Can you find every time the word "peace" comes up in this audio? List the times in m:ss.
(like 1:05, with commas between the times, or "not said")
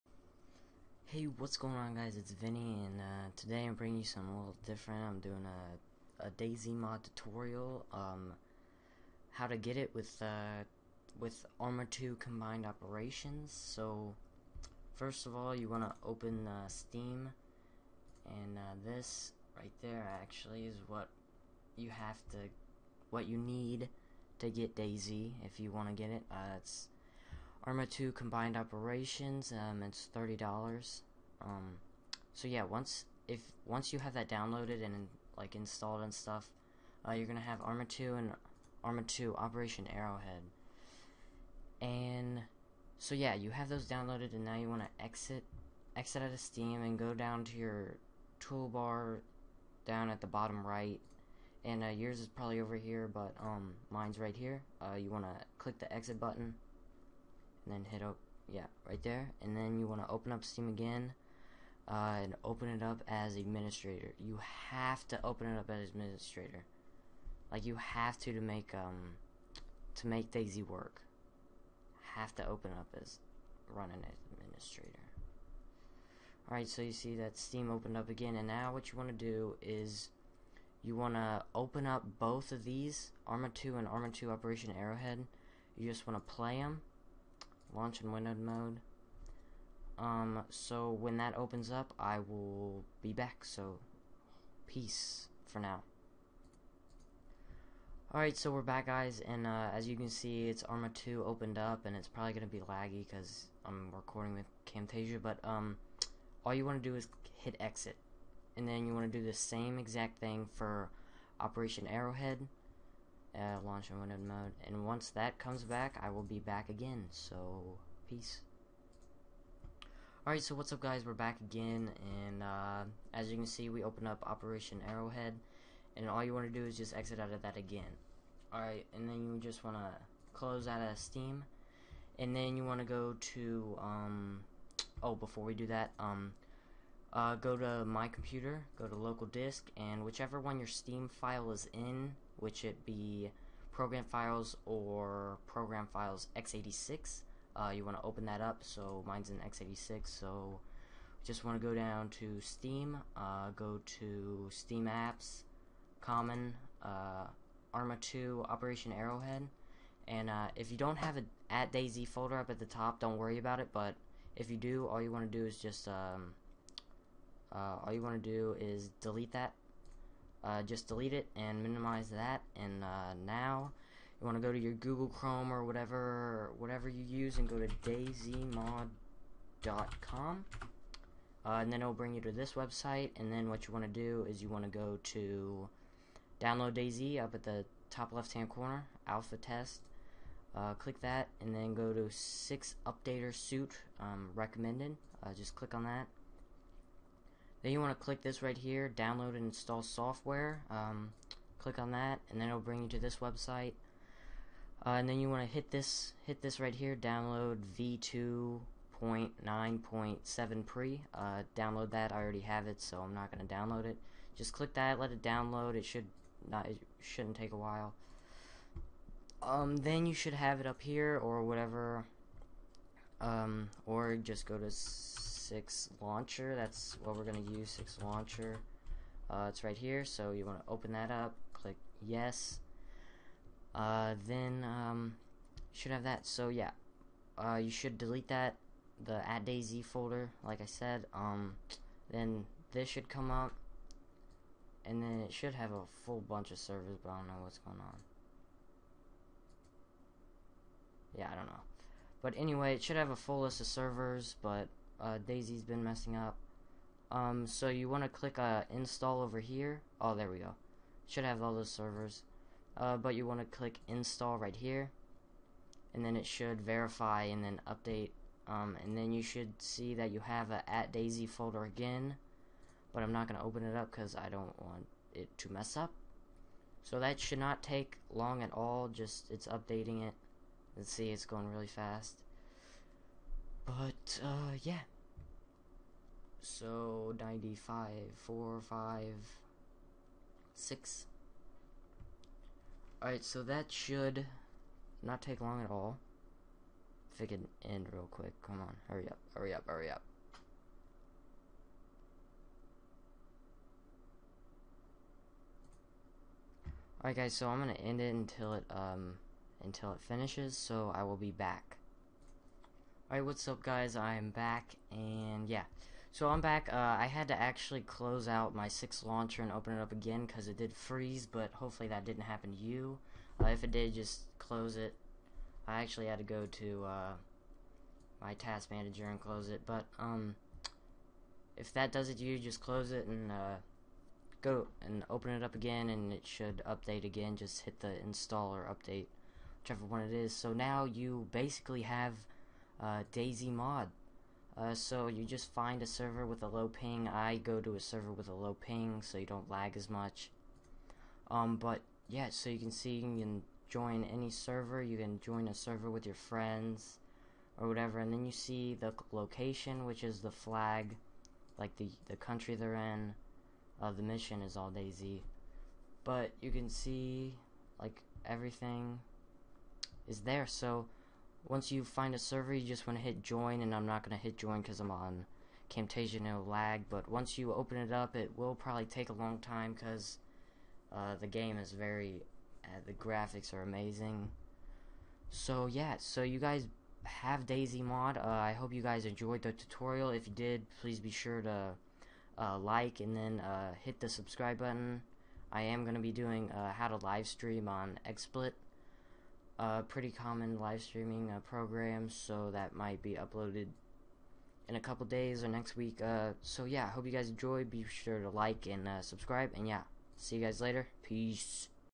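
1:34, 1:58, 6:51.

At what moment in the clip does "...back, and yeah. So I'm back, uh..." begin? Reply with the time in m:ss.
5:14.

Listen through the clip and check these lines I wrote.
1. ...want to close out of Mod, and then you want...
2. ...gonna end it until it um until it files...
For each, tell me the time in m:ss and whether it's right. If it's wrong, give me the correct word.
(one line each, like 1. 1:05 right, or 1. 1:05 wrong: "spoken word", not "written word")
1. 2:09 wrong: "Steam", not "Mod"
2. 5:07 wrong: "finishes", not "files".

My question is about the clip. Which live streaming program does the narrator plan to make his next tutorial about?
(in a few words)
XSplit.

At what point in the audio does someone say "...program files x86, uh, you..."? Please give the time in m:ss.
2:25.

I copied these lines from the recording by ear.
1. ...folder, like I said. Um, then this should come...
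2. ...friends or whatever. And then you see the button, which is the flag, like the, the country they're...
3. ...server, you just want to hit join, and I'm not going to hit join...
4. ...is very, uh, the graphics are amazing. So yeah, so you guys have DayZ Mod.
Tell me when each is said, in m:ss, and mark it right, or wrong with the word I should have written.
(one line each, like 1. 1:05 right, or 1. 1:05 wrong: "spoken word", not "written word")
1. 3:59 right
2. 5:56 wrong: "location", not "button"
3. 6:12 right
4. 6:21 right.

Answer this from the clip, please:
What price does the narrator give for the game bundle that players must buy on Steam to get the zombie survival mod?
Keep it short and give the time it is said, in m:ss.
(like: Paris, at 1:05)
$30, at 0:30.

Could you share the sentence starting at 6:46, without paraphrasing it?
Uh, so yeah, hope you guys enjoy.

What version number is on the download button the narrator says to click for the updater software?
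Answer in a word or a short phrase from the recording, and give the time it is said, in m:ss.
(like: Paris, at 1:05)
v2.9.7 pre, at 3:27.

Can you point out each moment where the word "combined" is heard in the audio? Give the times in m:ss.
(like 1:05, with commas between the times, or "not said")
0:12, 0:28.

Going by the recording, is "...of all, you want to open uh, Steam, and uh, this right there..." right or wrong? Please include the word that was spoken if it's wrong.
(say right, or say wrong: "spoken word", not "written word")
right.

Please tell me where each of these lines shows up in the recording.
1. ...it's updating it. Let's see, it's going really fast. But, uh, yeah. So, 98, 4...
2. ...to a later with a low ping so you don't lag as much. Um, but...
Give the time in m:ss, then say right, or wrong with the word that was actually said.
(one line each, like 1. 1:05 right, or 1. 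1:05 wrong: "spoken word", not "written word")
1. 4:39 wrong: "95", not "98"
2. 5:47 wrong: "server", not "later".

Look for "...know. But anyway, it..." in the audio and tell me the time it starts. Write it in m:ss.
4:11.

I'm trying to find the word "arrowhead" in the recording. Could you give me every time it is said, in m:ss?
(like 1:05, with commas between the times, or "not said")
0:39, 1:24, 1:51, 2:04, 2:38.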